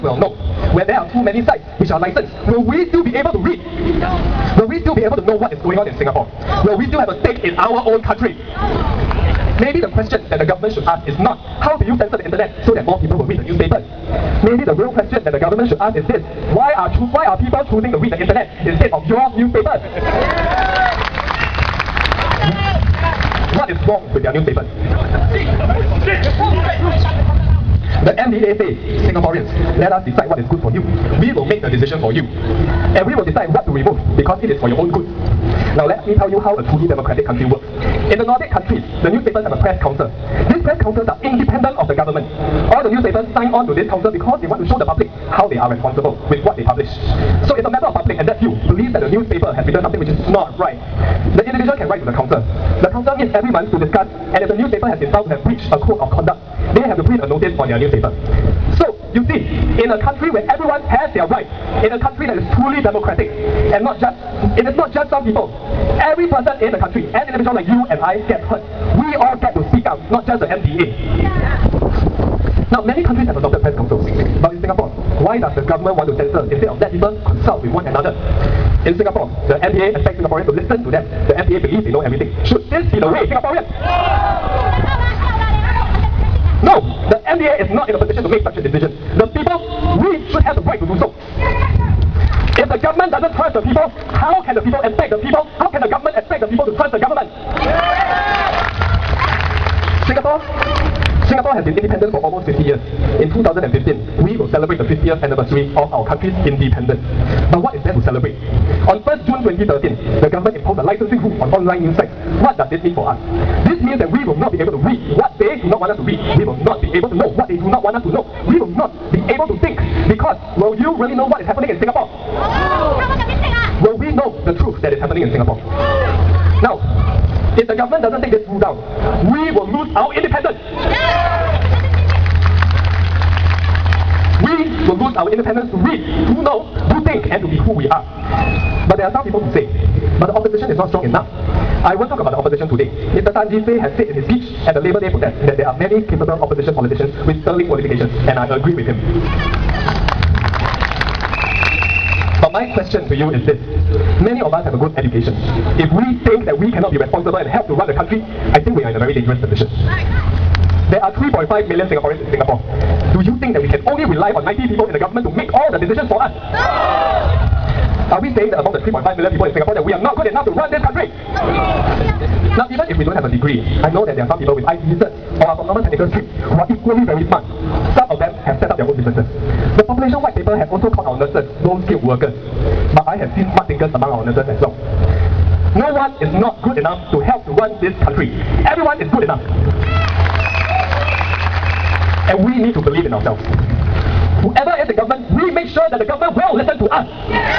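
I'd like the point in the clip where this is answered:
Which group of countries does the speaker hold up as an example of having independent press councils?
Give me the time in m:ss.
0:38.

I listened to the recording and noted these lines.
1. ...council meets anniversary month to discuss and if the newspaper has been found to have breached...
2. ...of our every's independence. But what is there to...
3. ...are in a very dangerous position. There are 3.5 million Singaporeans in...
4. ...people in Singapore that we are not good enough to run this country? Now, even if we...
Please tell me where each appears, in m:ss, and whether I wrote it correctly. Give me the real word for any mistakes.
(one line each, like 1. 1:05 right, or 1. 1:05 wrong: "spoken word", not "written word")
1. 0:52 wrong: "every", not "anniversary"
2. 1:45 wrong: "country", not "every"
3. 2:38 right
4. 2:49 right.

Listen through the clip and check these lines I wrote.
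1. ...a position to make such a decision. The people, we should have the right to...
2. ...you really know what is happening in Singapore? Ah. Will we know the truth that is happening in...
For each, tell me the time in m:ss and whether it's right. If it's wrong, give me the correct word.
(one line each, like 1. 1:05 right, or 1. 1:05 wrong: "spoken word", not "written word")
1. 1:27 right
2. 2:00 right.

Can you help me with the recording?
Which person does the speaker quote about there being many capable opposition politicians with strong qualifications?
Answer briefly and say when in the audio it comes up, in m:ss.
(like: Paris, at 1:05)
Tan Jee Say, at 2:23.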